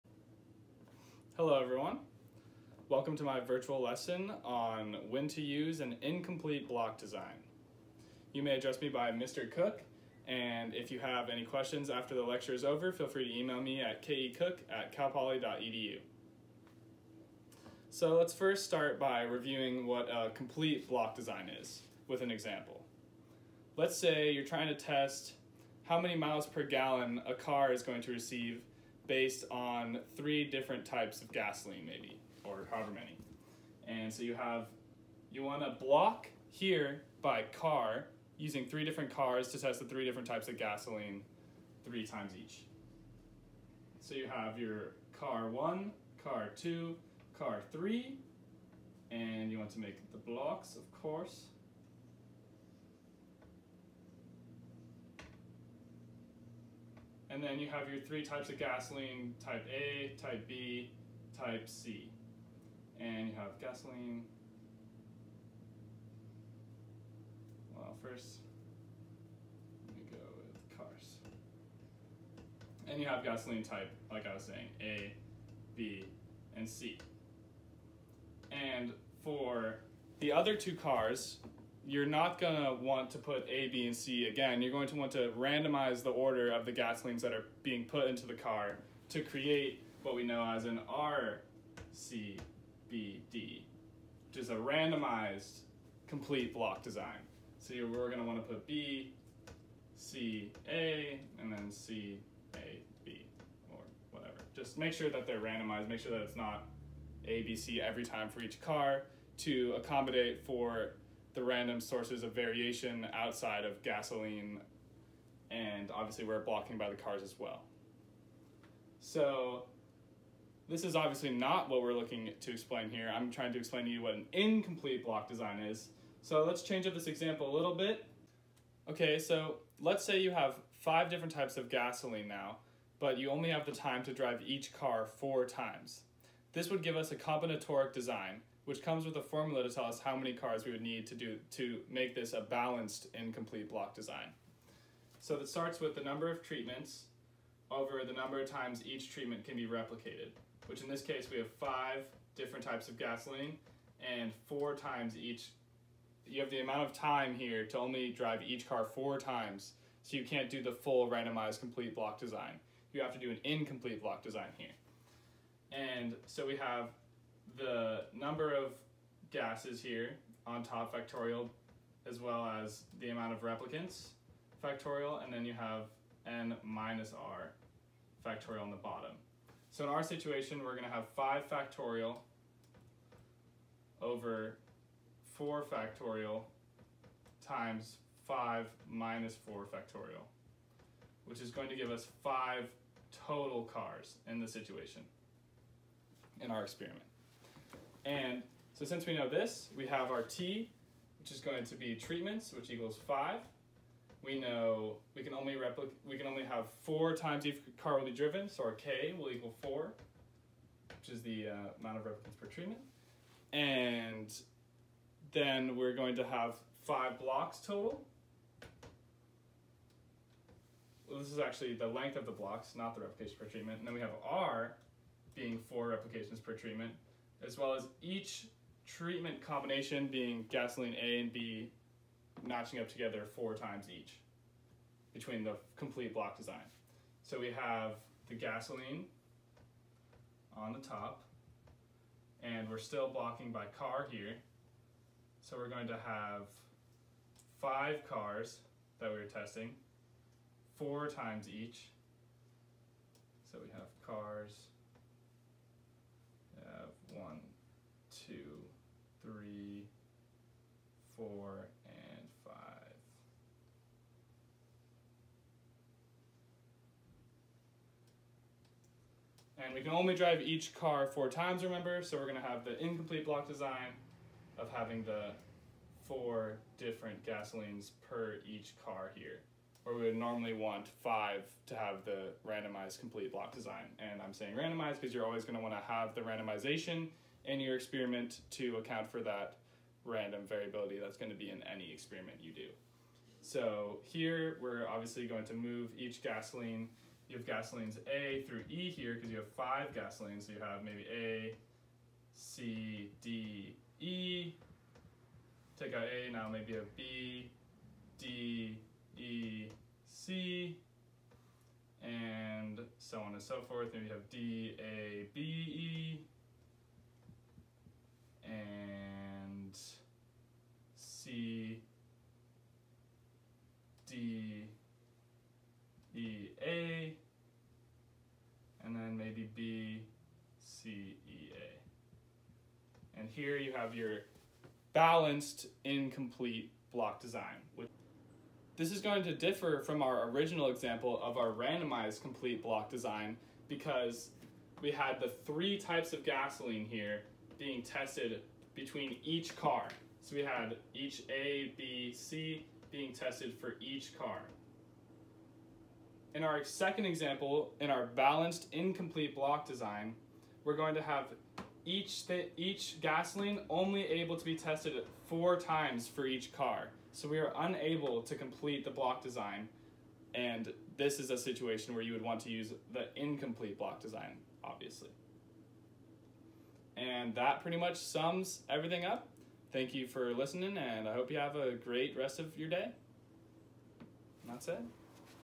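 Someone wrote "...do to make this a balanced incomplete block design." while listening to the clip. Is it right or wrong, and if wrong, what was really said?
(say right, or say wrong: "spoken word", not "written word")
right.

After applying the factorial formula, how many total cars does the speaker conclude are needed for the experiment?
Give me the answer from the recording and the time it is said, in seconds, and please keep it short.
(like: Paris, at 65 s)
5, at 192 s.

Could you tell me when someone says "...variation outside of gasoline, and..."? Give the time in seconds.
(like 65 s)
112 s.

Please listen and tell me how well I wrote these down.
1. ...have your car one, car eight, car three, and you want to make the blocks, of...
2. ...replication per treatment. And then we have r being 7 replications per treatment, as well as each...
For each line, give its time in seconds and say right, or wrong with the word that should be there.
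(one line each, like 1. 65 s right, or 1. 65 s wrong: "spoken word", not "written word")
1. 44 s wrong: "two", not "eight"
2. 223 s wrong: "4", not "7".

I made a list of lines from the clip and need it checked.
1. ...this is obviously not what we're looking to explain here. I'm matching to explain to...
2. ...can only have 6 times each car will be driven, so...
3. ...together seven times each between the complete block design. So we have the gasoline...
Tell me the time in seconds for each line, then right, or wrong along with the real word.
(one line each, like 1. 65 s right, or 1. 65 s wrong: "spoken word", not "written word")
1. 120 s wrong: "trying", not "matching"
2. 206 s wrong: "4", not "6"
3. 232 s wrong: "four", not "seven".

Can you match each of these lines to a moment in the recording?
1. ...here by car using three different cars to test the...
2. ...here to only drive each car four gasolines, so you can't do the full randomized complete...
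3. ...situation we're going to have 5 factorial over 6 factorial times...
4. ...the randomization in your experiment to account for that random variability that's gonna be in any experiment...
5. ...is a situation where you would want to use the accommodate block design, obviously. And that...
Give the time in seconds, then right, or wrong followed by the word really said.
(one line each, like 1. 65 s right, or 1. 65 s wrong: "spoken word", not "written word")
1. 36 s right
2. 157 s wrong: "times", not "gasolines"
3. 180 s wrong: "4", not "6"
4. 286 s right
5. 371 s wrong: "incomplete", not "accommodate".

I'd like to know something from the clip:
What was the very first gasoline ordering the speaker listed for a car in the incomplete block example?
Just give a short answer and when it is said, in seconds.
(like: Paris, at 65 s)
A, C, D, E, at 301 s.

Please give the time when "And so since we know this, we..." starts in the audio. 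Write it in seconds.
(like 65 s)
198 s.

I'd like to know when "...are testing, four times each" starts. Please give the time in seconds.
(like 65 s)
249 s.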